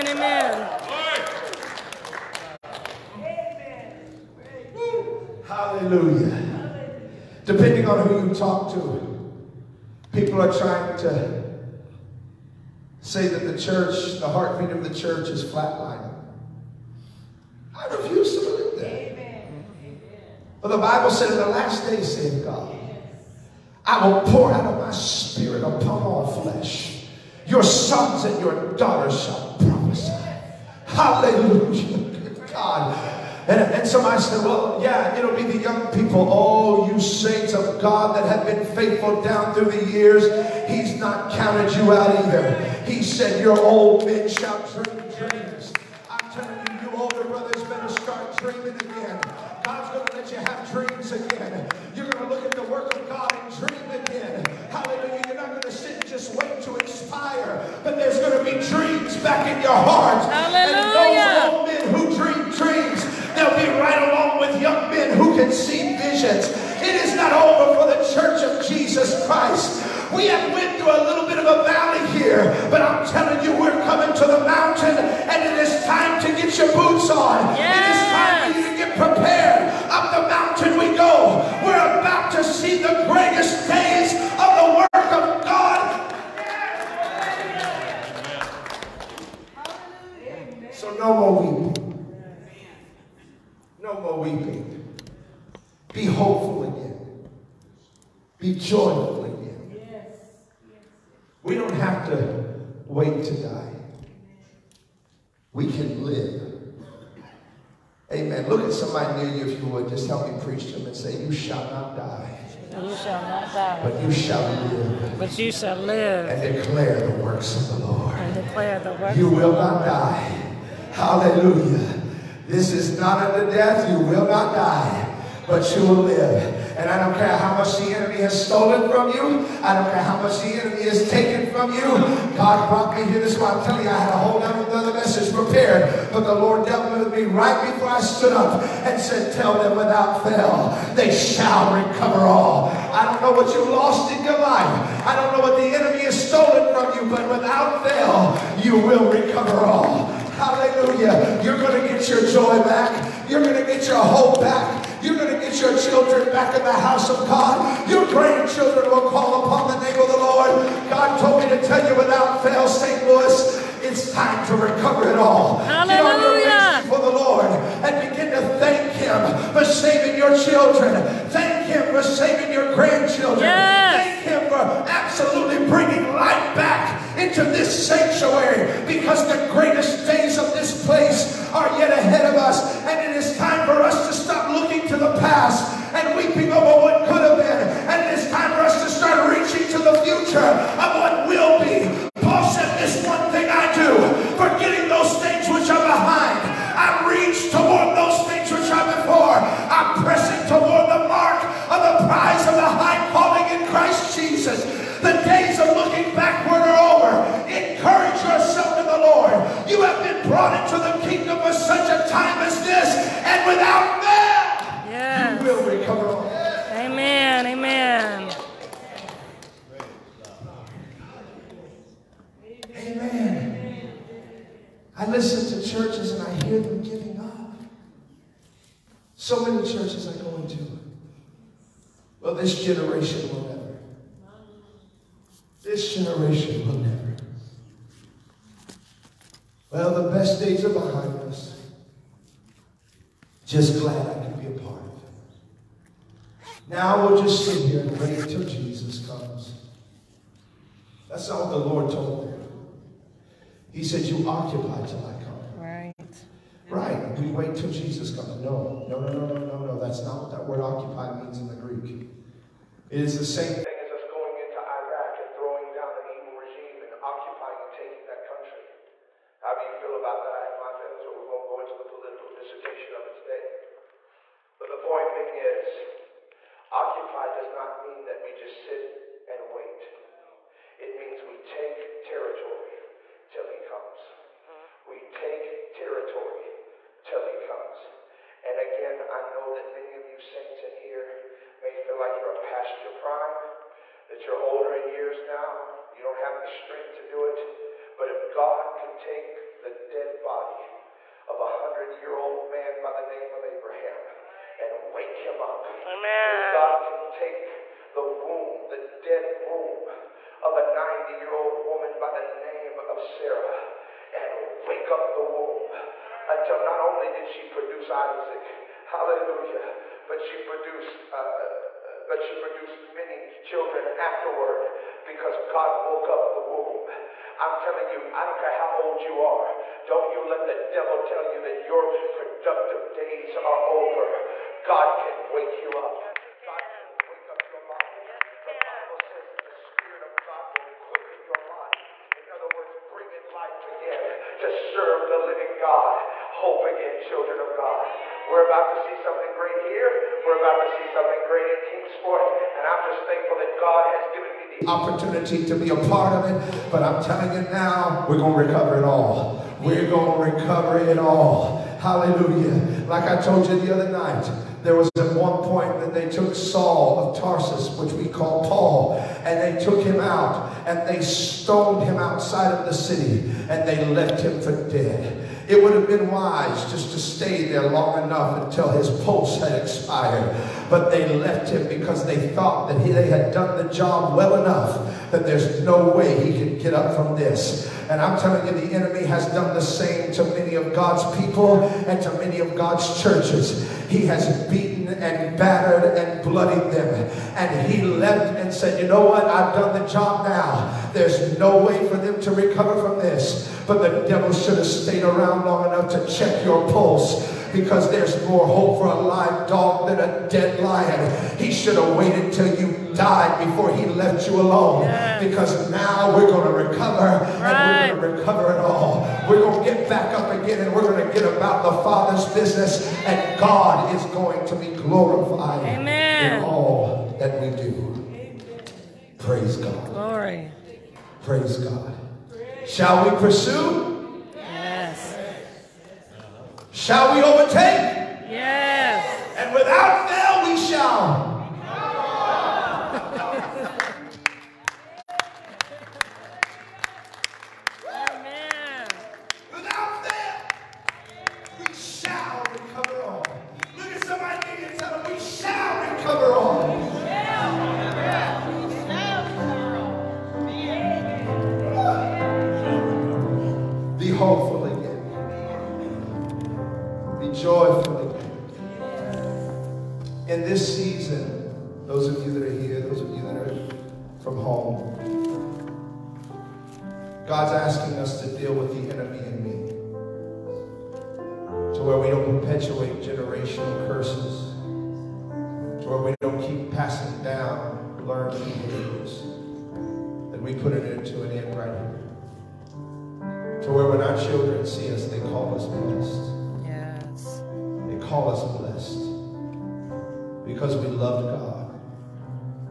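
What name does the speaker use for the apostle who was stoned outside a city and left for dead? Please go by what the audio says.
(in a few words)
Saul of Tarsus.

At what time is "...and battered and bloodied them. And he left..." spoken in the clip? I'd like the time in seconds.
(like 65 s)
395 s.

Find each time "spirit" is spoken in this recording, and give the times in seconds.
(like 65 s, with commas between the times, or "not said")
24 s, 339 s.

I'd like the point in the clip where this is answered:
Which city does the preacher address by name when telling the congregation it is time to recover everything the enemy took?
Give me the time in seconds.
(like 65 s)
162 s.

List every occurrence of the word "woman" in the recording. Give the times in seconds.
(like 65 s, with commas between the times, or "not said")
311 s.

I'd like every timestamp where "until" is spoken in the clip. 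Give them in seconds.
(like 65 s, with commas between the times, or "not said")
316 s, 378 s.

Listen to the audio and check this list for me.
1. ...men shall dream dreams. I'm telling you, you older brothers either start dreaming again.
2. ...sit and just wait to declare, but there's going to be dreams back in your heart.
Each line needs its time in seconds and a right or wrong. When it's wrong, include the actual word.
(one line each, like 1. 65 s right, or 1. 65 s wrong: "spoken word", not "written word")
1. 44 s wrong: "better", not "either"
2. 55 s wrong: "expire", not "declare".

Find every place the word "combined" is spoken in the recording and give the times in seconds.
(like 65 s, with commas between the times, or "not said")
not said.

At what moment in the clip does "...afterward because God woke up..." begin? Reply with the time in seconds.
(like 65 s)
323 s.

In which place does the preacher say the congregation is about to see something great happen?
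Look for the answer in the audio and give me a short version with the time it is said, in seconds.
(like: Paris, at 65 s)
Kingsport, at 351 s.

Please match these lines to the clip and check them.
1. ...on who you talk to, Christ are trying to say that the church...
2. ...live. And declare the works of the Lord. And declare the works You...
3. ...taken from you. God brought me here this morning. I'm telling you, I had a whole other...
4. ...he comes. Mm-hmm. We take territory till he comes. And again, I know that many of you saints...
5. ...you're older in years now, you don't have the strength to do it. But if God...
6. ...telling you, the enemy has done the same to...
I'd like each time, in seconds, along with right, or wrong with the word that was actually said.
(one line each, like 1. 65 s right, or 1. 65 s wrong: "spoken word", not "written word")
1. 7 s wrong: "People", not "Christ"
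2. 115 s right
3. 131 s right
4. 283 s right
5. 294 s right
6. 388 s right.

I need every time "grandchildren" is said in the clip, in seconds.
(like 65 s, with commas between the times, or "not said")
158 s, 172 s.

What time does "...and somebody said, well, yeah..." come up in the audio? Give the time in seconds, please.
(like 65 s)
33 s.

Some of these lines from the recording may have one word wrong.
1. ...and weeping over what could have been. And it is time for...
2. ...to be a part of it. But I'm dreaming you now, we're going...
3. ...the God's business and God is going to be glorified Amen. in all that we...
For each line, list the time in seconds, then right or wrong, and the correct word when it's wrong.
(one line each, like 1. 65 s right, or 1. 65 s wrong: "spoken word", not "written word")
1. 185 s right
2. 355 s wrong: "telling", not "dreaming"
3. 421 s wrong: "Father", not "God".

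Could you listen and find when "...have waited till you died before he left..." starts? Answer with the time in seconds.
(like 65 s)
411 s.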